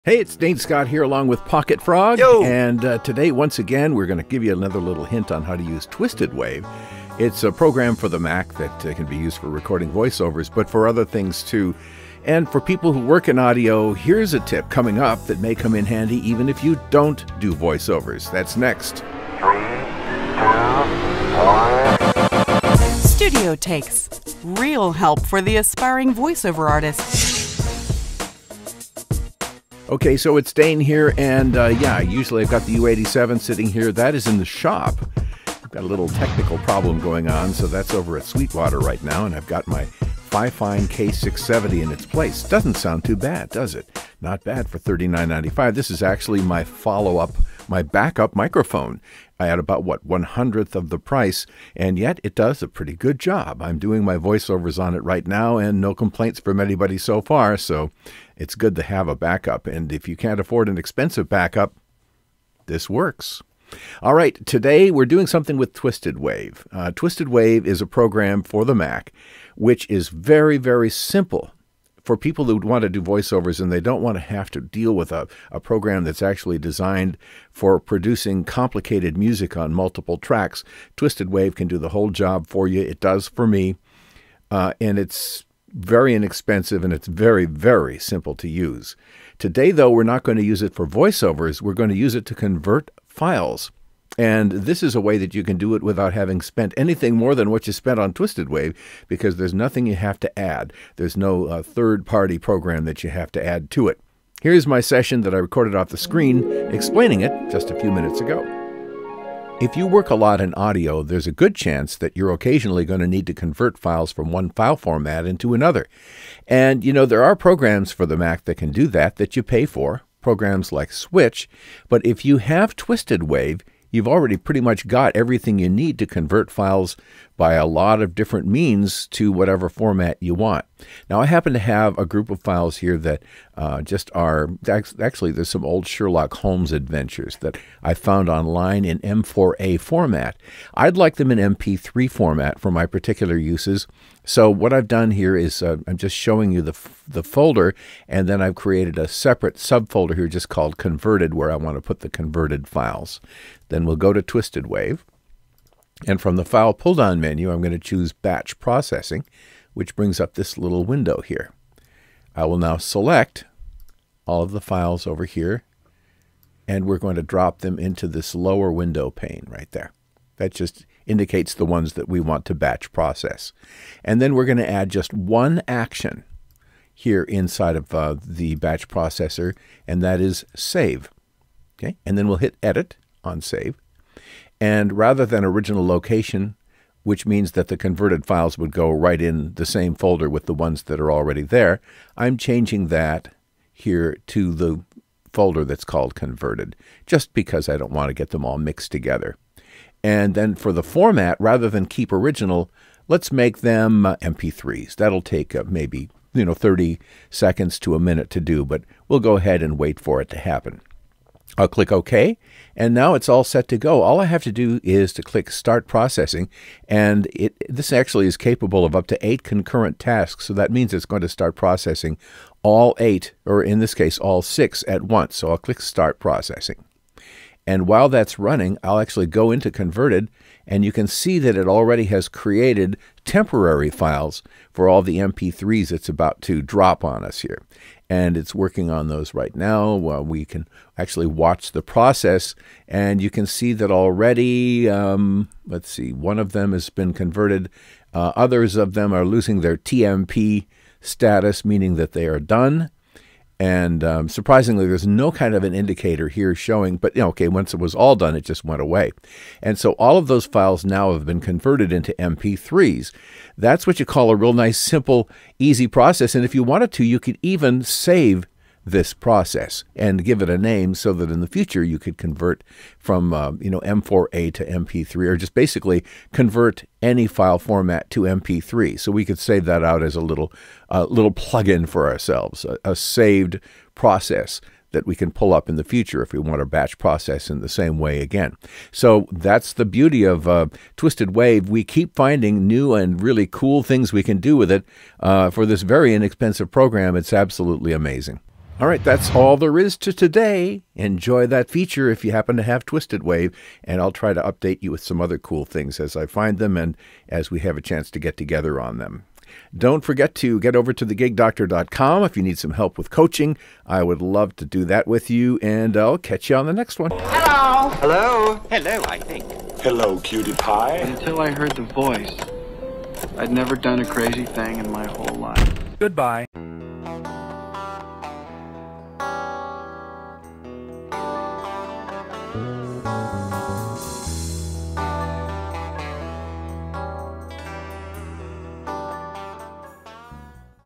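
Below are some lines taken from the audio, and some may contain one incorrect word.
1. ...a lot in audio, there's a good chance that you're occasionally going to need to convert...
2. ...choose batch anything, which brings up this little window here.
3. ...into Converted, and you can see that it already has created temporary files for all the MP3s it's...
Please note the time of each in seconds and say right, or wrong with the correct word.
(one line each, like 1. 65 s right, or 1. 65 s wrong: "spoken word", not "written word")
1. 110 s right
2. 157 s wrong: "processing", not "anything"
3. 229 s right.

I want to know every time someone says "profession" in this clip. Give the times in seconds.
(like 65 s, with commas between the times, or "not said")
not said.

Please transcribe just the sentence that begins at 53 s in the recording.
I'm doing my voiceovers on it right now, and no complaints from anybody so far.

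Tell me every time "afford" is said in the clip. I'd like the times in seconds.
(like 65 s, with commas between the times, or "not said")
60 s.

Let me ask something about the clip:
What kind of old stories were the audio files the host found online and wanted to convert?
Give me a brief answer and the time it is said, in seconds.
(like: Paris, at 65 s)
Sherlock Holmes adventures, at 135 s.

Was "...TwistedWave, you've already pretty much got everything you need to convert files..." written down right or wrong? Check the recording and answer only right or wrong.
right.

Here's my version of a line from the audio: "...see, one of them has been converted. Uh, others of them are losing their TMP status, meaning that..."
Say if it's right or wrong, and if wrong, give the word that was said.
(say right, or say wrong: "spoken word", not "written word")
right.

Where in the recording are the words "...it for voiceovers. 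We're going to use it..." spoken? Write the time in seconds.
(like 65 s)
90 s.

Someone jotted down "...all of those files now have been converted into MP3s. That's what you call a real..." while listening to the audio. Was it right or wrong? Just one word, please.
right.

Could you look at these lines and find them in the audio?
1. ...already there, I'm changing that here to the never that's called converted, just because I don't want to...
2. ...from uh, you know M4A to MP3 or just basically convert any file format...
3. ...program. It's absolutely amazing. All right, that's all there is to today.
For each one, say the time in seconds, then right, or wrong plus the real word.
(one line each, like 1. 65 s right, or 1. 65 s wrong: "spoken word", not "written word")
1. 191 s wrong: "folder", not "never"
2. 272 s right
3. 296 s right.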